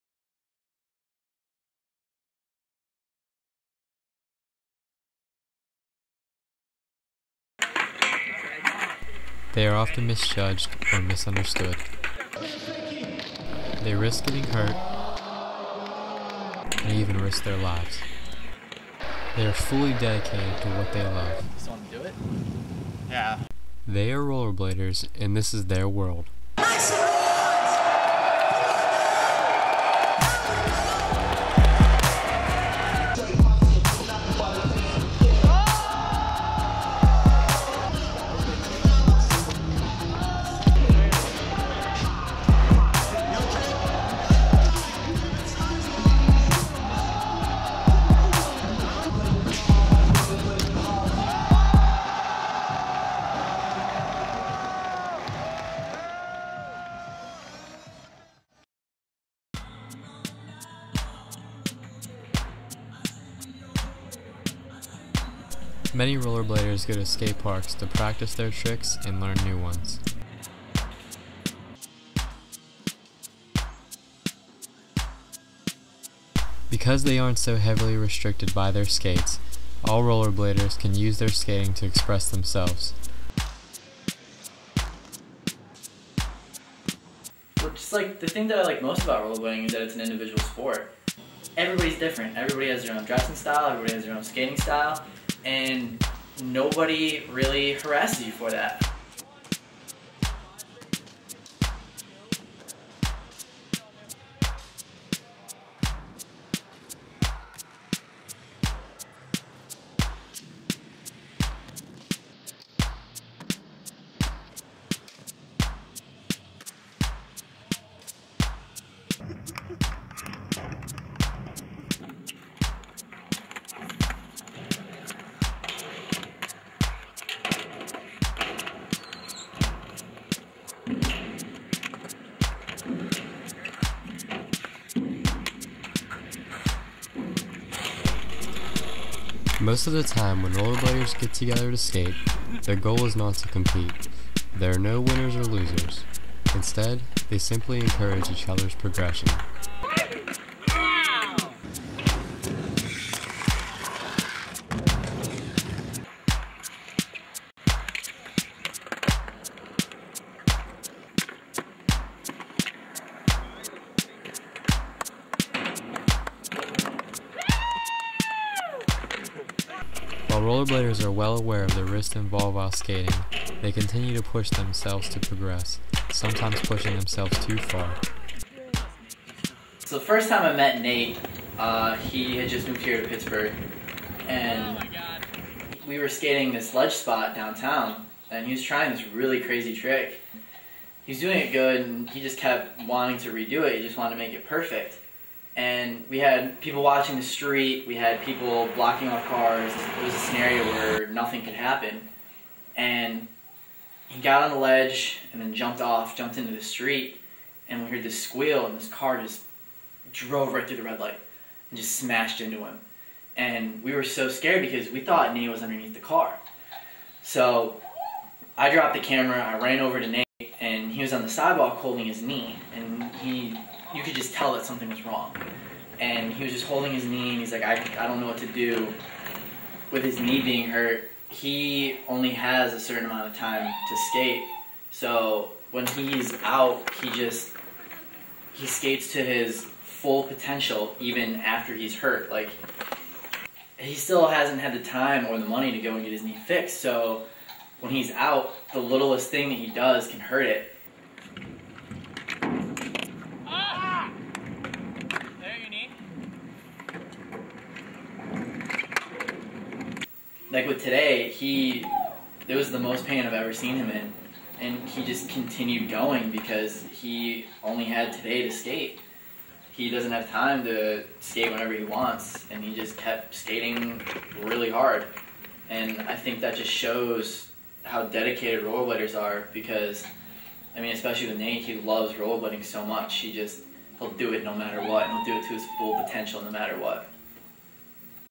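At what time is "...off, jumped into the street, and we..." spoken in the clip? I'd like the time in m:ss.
3:25.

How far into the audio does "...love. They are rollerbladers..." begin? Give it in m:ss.
0:21.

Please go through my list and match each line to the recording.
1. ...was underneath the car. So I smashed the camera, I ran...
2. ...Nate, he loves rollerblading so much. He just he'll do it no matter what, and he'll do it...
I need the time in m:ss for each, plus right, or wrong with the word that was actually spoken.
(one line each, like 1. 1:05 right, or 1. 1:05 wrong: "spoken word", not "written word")
1. 3:35 wrong: "dropped", not "smashed"
2. 4:41 right.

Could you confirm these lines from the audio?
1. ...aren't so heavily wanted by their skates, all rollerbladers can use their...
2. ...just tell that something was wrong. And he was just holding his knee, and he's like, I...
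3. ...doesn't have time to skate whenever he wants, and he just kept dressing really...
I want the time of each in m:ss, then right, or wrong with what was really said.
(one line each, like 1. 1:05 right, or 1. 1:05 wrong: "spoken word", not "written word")
1. 1:17 wrong: "restricted", not "wanted"
2. 3:44 right
3. 4:29 wrong: "skating", not "dressing".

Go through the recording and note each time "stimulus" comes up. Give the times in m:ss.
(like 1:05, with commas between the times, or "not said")
not said.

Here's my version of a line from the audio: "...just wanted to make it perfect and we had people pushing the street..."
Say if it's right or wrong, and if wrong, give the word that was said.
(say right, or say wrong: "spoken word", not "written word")
wrong: "watching", not "pushing".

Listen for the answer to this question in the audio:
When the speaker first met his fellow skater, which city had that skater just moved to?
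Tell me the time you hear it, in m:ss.
3:03.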